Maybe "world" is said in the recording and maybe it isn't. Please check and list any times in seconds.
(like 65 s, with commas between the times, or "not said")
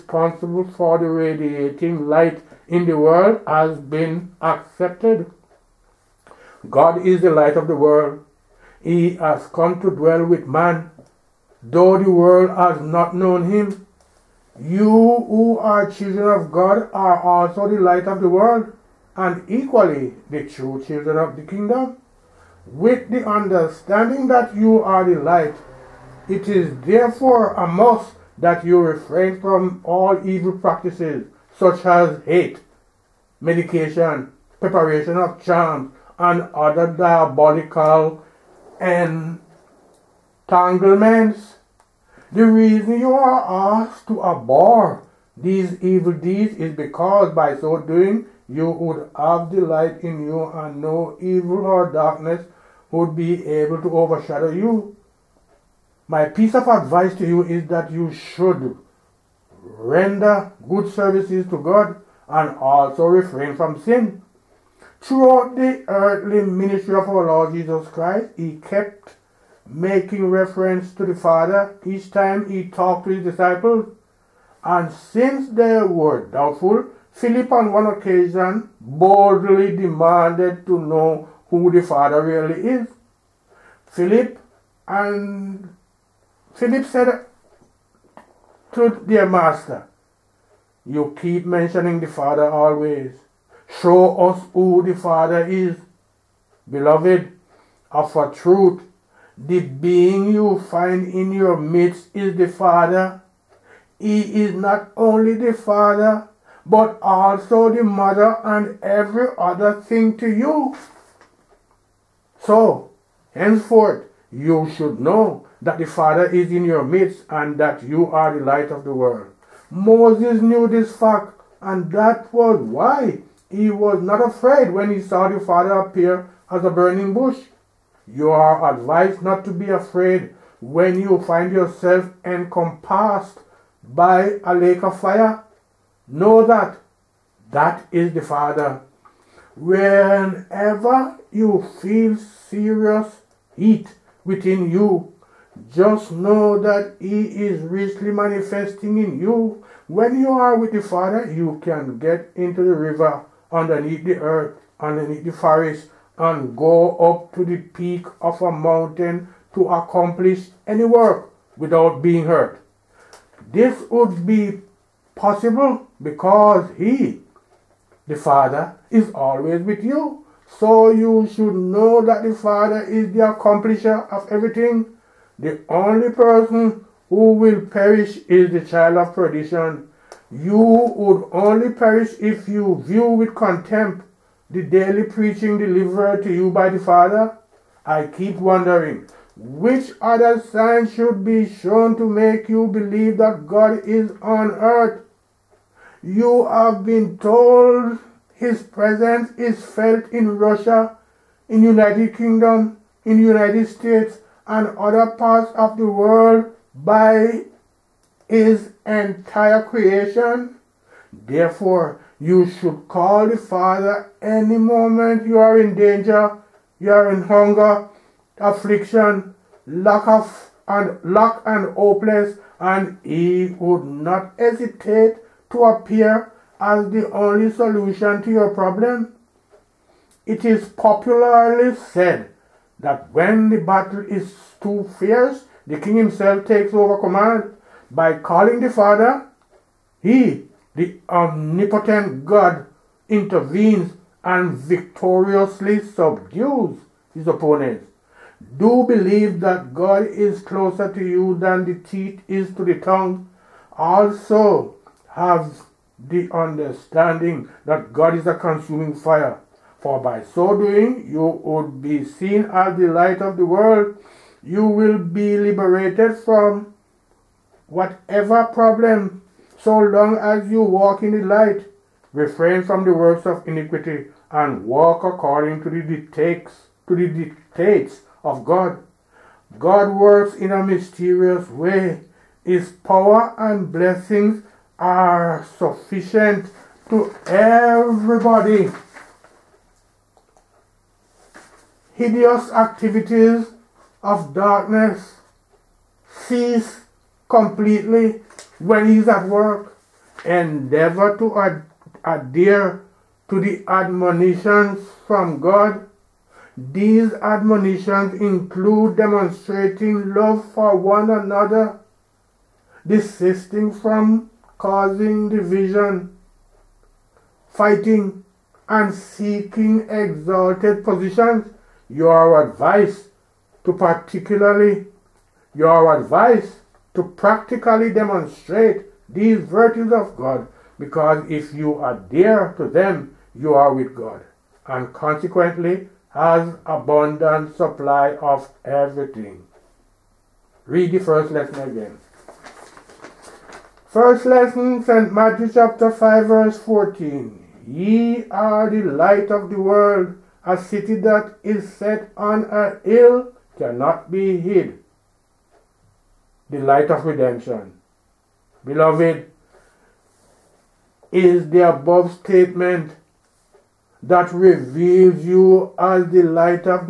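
2 s, 7 s, 12 s, 18 s, 118 s, 205 s, 263 s, 349 s.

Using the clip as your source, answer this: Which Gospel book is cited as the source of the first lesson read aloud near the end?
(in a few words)
St. Matthew.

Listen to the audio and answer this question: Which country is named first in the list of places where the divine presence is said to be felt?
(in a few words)
Russia.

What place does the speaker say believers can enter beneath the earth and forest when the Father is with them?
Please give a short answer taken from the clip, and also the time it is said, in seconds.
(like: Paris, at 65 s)
The river, at 152 s.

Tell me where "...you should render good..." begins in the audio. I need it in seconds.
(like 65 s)
57 s.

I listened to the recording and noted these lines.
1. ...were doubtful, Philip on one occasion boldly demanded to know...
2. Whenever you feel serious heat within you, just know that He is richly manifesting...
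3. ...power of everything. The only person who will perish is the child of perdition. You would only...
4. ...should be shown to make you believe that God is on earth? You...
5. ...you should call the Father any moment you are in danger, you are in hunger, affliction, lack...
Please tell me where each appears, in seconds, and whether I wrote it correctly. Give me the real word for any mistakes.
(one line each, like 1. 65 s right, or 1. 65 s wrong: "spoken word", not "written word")
1. 75 s right
2. 139 s right
3. 173 s wrong: "accomplisher", not "power"
4. 190 s right
5. 212 s right.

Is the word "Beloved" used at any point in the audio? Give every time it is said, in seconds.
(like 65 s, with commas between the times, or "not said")
96 s, 358 s.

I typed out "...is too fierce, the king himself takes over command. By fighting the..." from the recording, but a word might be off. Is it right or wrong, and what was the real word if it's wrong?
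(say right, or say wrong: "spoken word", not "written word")
wrong: "calling", not "fighting".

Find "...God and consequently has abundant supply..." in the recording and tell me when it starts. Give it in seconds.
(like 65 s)
333 s.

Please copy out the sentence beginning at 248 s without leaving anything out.
Do believe that God is closer to you than the teeth is to the tongue.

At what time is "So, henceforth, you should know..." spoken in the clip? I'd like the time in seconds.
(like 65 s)
112 s.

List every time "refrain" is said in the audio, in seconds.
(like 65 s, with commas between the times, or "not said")
28 s, 63 s, 272 s.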